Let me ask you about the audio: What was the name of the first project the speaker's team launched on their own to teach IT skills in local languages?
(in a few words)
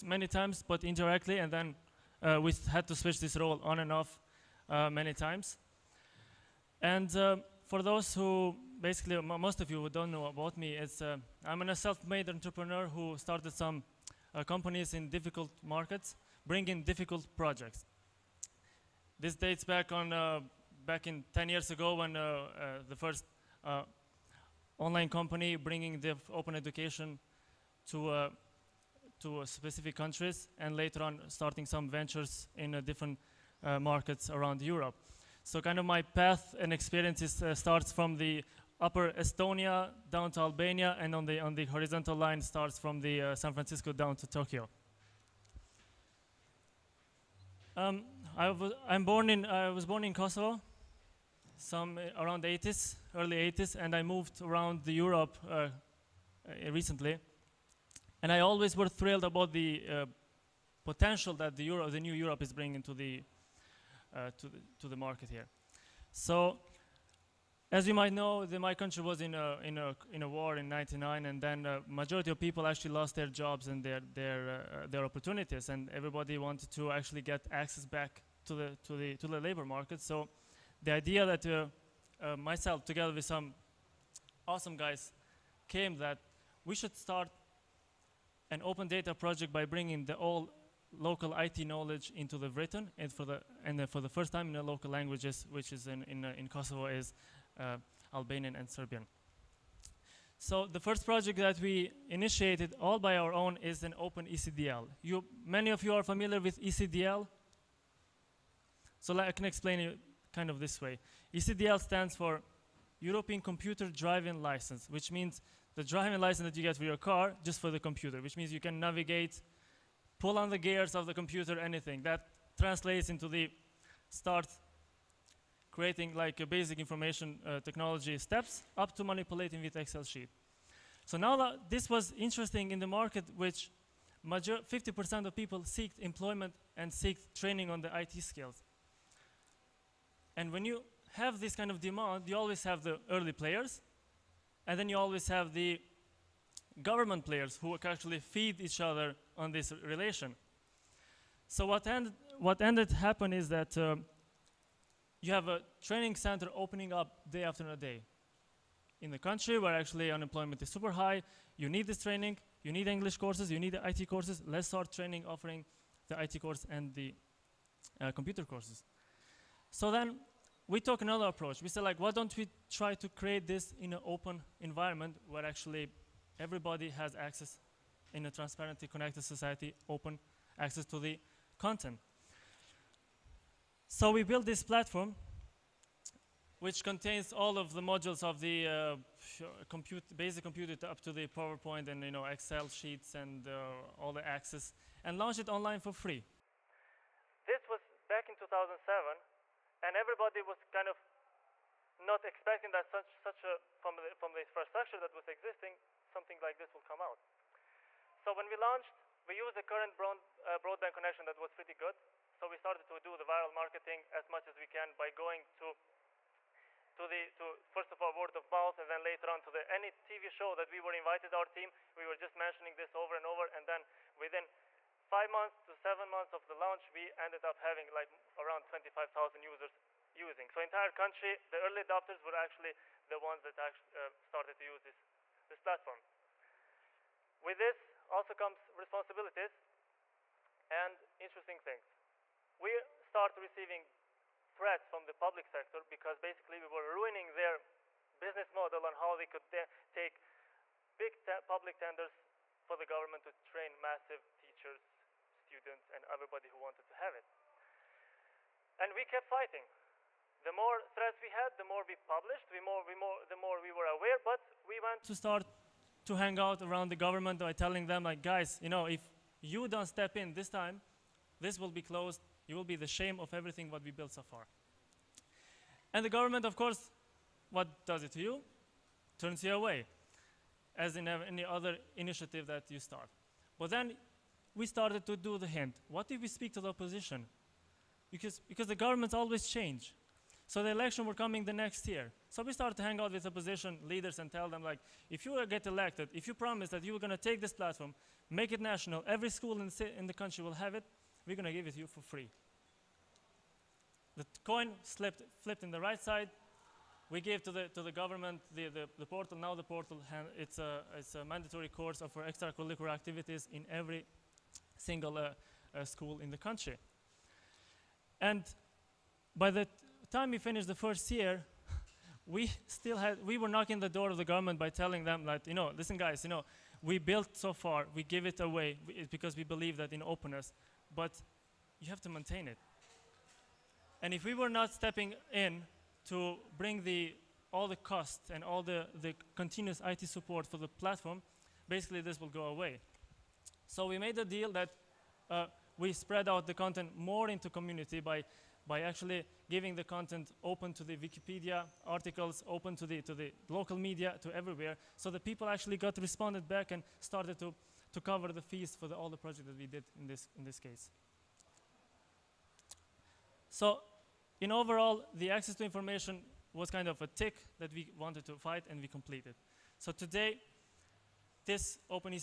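Open ECDL.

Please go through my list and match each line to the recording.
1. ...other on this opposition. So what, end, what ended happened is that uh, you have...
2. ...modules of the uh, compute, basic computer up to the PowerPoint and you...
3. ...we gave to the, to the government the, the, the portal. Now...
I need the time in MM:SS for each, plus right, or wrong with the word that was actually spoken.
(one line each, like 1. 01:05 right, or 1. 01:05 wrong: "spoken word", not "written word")
1. 02:28 wrong: "relation", not "opposition"
2. 03:07 right
3. 05:07 right.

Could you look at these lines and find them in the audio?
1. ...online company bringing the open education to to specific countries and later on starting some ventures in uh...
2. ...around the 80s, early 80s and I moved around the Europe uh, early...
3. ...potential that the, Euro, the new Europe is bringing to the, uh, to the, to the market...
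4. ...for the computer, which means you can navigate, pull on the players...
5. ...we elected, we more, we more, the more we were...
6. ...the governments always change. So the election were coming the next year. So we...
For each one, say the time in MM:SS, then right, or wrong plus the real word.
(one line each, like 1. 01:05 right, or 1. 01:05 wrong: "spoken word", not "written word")
1. 00:24 right
2. 00:52 wrong: "recently", not "early"
3. 01:00 right
4. 01:57 wrong: "gears", not "players"
5. 04:21 wrong: "published", not "elected"
6. 04:48 right.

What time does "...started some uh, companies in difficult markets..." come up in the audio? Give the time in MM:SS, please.
00:13.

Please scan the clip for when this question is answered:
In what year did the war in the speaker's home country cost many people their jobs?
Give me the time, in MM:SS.
01:10.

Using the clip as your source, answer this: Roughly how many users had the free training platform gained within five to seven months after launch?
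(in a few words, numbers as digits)
25,000.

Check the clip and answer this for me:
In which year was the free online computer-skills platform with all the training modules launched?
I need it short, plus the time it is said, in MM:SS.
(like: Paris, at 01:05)
2007, at 03:18.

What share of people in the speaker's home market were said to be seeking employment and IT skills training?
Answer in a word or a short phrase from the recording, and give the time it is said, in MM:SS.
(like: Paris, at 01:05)
50%, at 02:14.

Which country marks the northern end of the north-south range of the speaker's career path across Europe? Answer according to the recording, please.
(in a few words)
Estonia.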